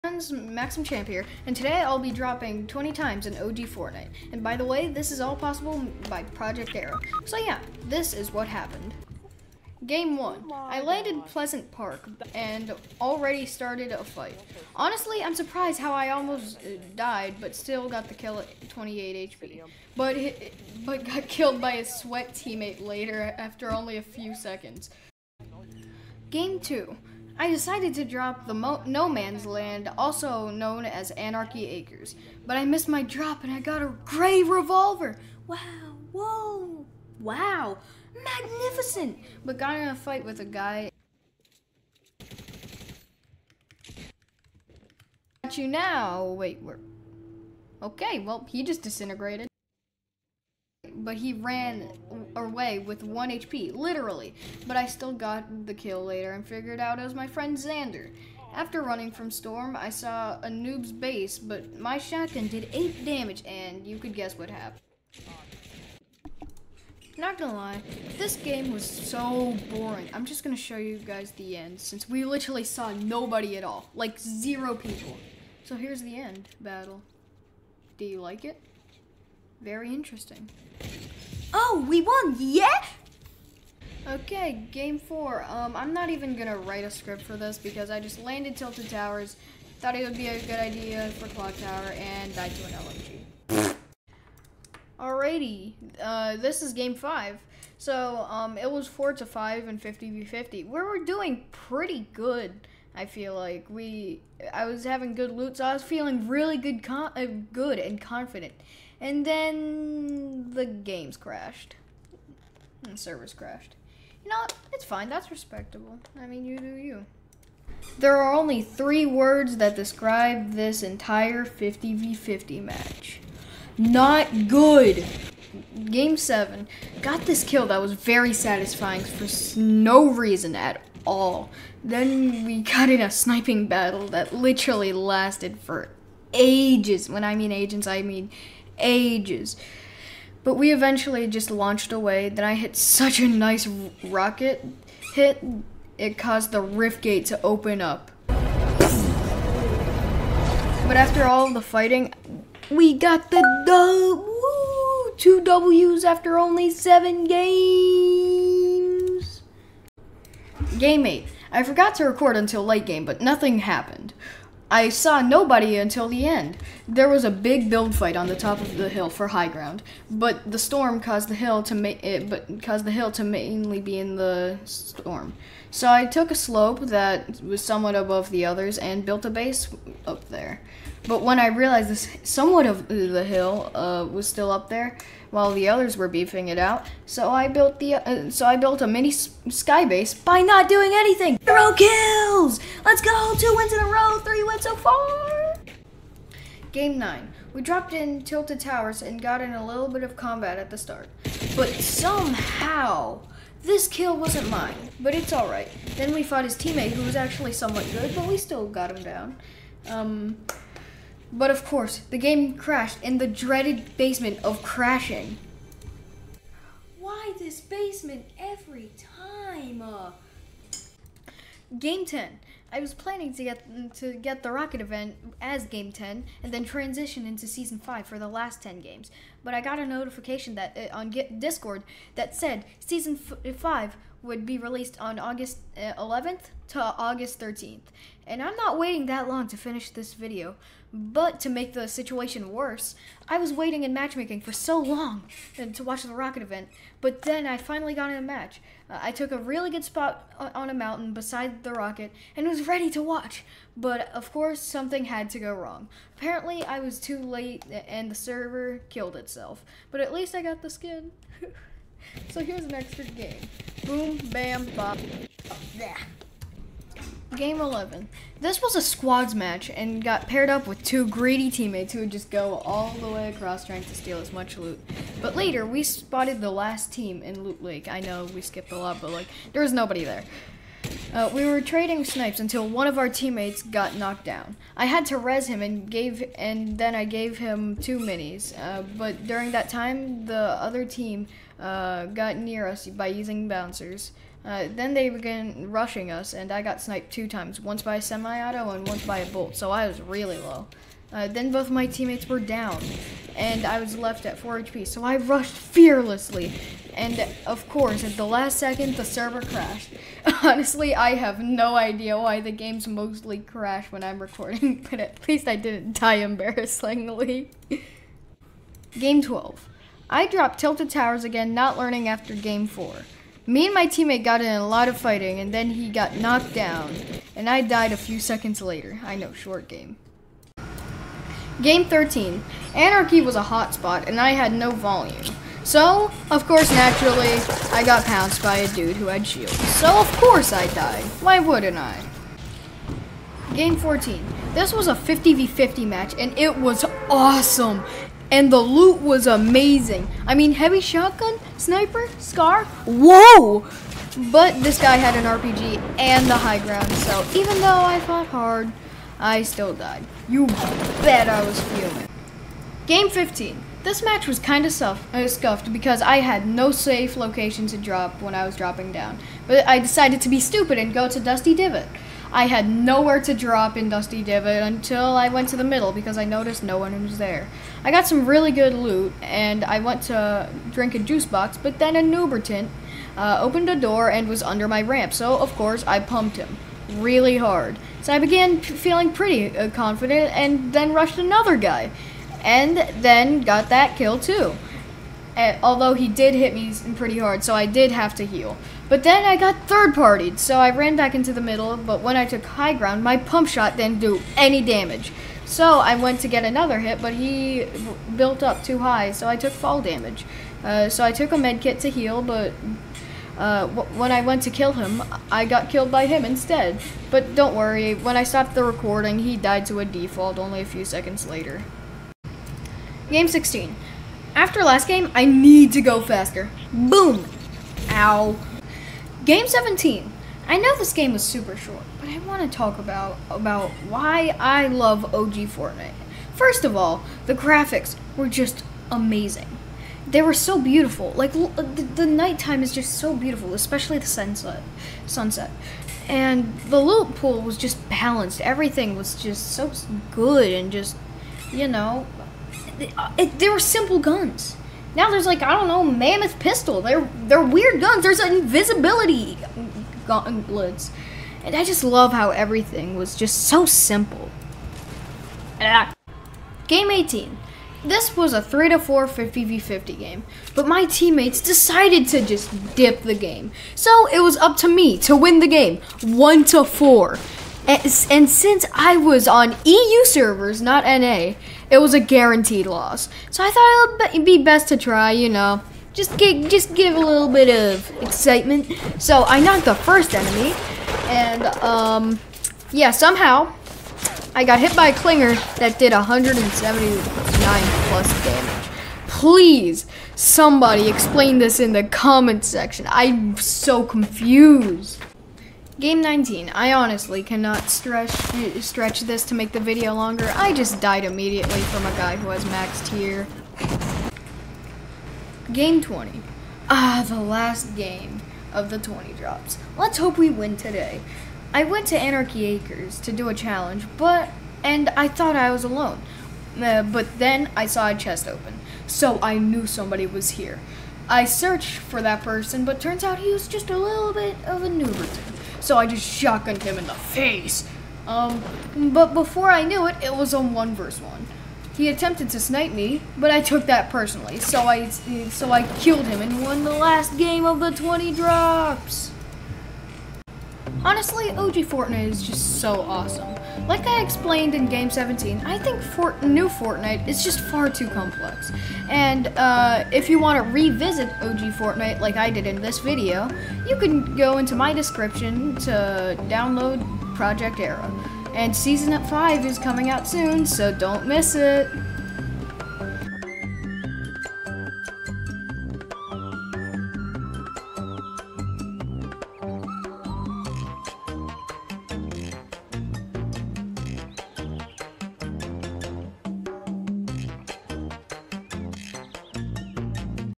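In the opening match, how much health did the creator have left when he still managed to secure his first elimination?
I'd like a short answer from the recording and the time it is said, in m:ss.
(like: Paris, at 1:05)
28 HP, at 0:18.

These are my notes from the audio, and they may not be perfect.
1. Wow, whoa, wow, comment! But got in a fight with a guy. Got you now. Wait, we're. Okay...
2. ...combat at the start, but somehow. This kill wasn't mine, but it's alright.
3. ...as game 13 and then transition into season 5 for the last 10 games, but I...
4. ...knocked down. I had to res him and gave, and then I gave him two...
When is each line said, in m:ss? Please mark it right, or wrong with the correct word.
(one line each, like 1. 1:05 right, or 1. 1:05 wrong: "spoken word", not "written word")
1. 0:35 wrong: "magnificent", not "comment"
2. 3:20 right
3. 3:45 wrong: "10", not "13"
4. 4:43 right.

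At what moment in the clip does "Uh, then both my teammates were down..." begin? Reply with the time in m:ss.
5:01.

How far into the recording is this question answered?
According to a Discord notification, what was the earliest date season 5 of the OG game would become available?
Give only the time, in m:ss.
3:55.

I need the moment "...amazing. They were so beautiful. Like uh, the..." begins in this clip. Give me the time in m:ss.
7:18.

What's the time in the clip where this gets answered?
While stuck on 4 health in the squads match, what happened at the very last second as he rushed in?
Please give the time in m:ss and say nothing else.
5:08.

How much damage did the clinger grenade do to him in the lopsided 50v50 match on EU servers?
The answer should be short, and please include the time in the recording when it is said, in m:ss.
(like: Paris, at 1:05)
179+, at 8:15.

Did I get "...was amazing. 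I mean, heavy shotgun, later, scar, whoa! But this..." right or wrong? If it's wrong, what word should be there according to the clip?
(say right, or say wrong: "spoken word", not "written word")
wrong: "sniper", not "later".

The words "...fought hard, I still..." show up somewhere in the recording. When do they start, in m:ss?
5:58.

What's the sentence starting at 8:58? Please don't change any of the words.
Um, but before I knew it, it was a one versus one.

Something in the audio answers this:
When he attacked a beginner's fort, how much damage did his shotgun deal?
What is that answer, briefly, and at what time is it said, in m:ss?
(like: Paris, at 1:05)
8, at 1:02.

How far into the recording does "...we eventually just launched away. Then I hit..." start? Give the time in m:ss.
2:20.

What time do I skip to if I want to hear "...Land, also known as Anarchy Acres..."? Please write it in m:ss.
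0:29.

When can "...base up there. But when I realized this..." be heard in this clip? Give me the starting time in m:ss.
2:59.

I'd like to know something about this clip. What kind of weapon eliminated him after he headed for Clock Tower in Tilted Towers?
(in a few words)
LMG.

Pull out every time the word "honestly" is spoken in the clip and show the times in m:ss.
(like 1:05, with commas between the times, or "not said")
0:14, 5:10, 8:26, 9:10.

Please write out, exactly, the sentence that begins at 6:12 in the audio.
I had nowhere to drop in Dusty Divot until I went to the middle because I noticed no one was there.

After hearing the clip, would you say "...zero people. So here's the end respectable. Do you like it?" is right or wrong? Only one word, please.
wrong.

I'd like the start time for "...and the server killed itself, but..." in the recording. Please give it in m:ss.
4:17.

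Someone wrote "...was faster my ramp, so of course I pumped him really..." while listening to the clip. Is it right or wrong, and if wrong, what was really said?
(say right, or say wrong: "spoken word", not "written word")
wrong: "under", not "faster".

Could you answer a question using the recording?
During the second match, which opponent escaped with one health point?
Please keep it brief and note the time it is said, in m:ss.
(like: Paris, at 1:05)
Xander, at 0:57.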